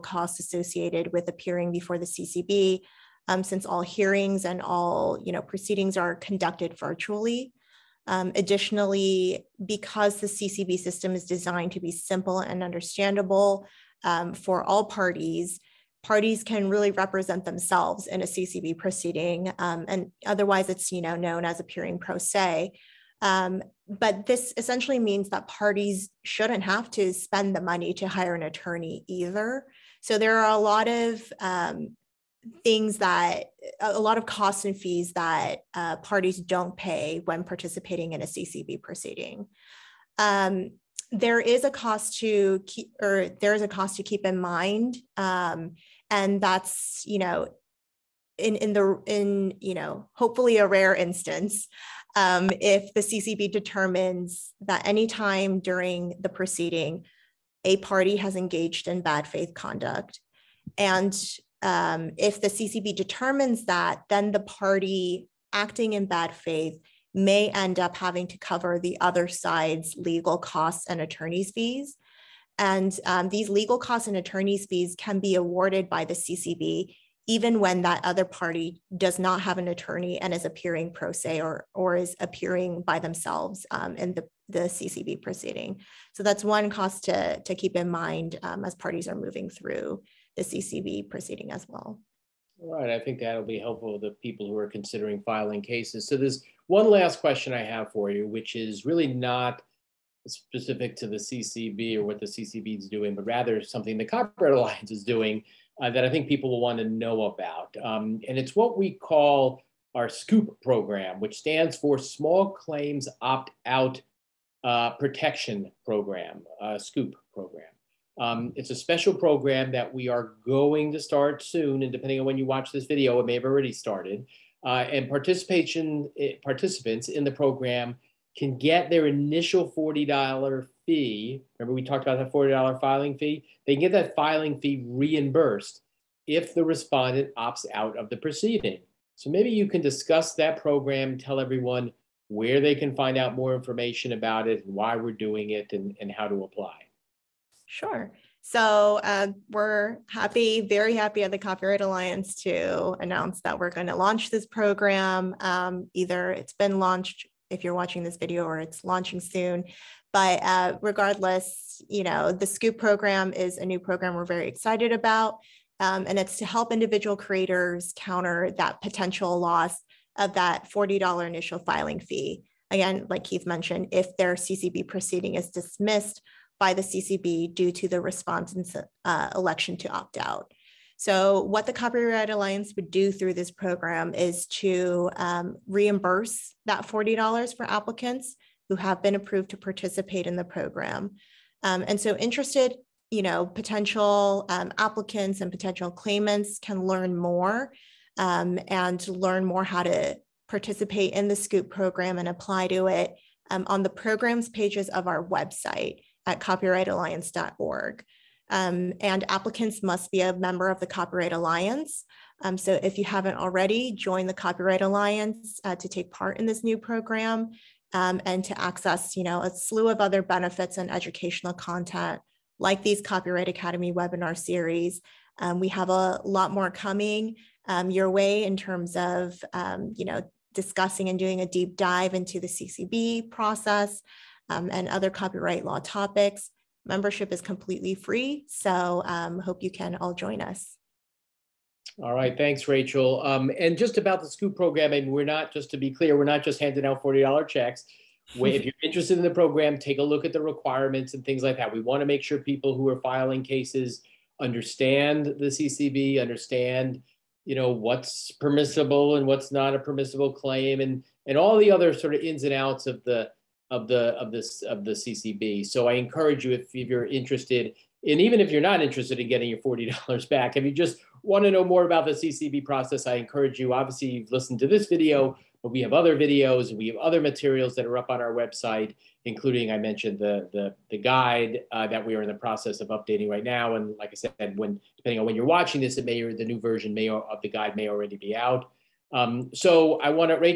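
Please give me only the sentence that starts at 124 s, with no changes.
Uh, and participation eh, participants in the program can get their initial $40 fee.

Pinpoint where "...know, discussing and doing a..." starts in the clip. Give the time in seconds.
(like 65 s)
230 s.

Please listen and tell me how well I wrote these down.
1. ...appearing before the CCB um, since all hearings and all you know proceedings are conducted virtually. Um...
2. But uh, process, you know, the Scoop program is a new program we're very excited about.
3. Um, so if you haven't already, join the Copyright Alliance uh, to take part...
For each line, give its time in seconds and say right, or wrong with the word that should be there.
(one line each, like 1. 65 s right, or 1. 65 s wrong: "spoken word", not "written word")
1. 1 s right
2. 160 s wrong: "regardless", not "process"
3. 212 s right.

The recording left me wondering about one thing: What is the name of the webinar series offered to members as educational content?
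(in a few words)
Copyright Academy.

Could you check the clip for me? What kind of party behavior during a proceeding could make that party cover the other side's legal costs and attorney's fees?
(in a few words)
bad faith conduct.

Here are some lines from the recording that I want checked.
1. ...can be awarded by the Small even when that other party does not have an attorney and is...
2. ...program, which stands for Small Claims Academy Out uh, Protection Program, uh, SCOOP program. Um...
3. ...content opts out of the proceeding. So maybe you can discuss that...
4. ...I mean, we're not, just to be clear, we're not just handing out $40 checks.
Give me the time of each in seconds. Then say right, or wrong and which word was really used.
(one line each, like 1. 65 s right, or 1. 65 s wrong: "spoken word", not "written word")
1. 74 s wrong: "CCB", not "Small"
2. 110 s wrong: "Opt", not "Academy"
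3. 136 s wrong: "respondent", not "content"
4. 244 s right.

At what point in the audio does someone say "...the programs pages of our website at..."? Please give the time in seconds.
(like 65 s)
203 s.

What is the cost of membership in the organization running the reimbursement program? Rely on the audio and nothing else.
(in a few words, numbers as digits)
free.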